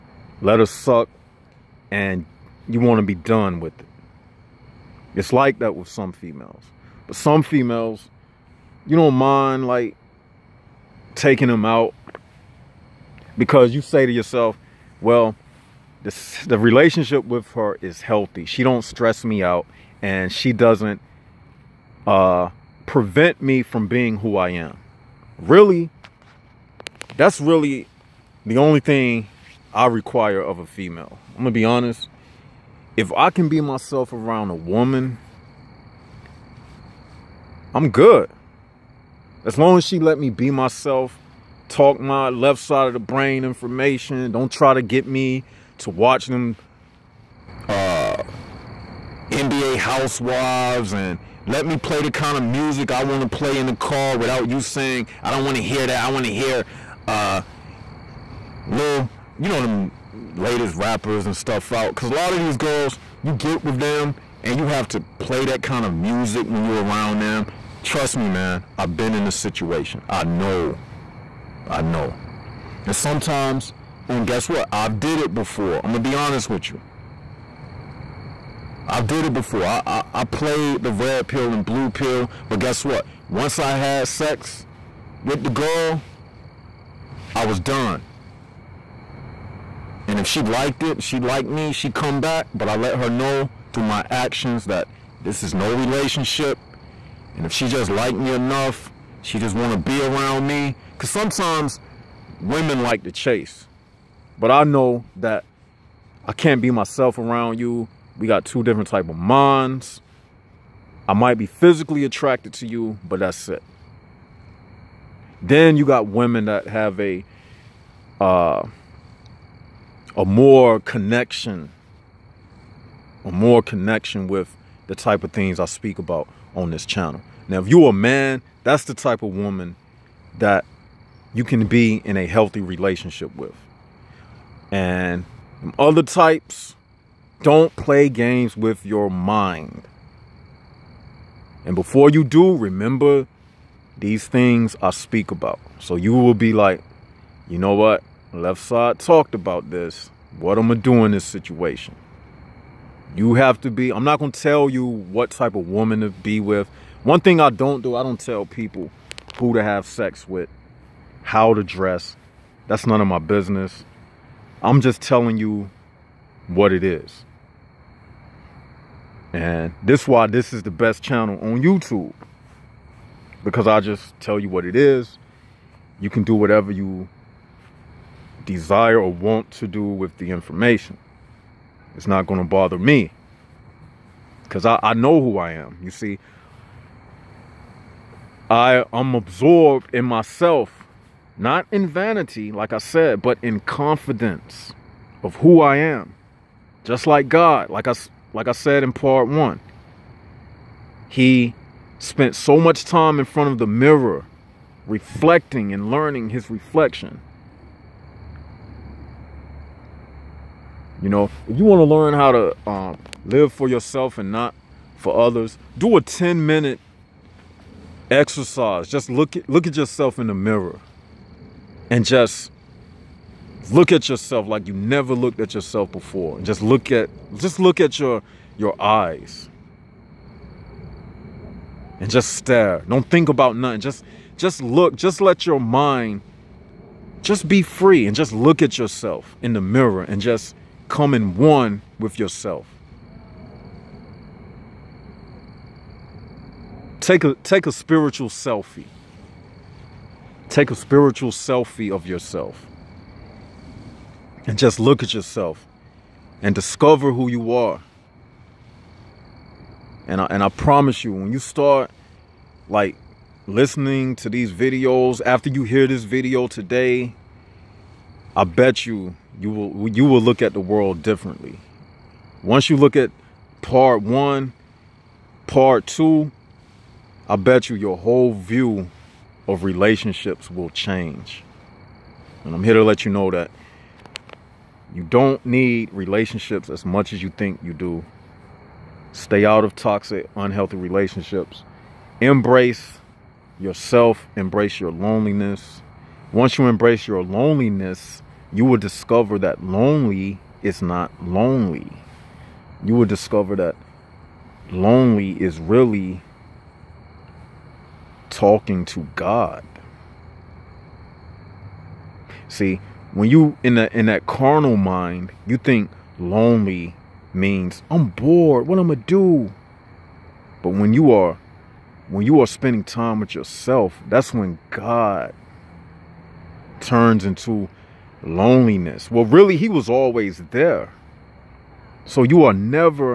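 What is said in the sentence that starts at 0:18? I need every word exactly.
She don't stress me out and she doesn't uh, prevent me from being who I am.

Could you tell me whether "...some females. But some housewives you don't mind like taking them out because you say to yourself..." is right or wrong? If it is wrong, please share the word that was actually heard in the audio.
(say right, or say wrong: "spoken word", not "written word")
wrong: "females", not "housewives".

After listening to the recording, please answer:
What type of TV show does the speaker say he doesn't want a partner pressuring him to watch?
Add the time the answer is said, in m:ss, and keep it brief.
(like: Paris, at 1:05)
NBA housewives, at 0:49.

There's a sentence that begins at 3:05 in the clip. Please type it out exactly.
You see, I, I'm absorbed in myself, not in vanity, like I said, but in confidence of who I am.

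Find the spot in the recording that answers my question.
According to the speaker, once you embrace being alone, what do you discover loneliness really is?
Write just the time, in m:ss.
5:08.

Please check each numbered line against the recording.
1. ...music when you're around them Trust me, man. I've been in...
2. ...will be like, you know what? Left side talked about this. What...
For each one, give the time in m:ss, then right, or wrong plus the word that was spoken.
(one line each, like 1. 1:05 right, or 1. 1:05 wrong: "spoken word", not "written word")
1. 1:05 right
2. 2:26 right.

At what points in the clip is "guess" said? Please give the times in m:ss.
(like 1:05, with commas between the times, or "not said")
1:14, 1:22.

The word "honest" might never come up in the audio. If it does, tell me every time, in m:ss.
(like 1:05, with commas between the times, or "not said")
0:31, 1:16.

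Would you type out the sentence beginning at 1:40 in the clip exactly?
Because sometimes women like to chase.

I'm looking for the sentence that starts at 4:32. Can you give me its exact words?
Once you look at part one, part two, I bet you your whole view of relationships will change.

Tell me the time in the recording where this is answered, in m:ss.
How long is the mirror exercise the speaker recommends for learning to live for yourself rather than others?
3:36.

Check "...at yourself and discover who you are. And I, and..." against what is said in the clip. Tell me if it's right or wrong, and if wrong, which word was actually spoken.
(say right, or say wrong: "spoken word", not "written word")
right.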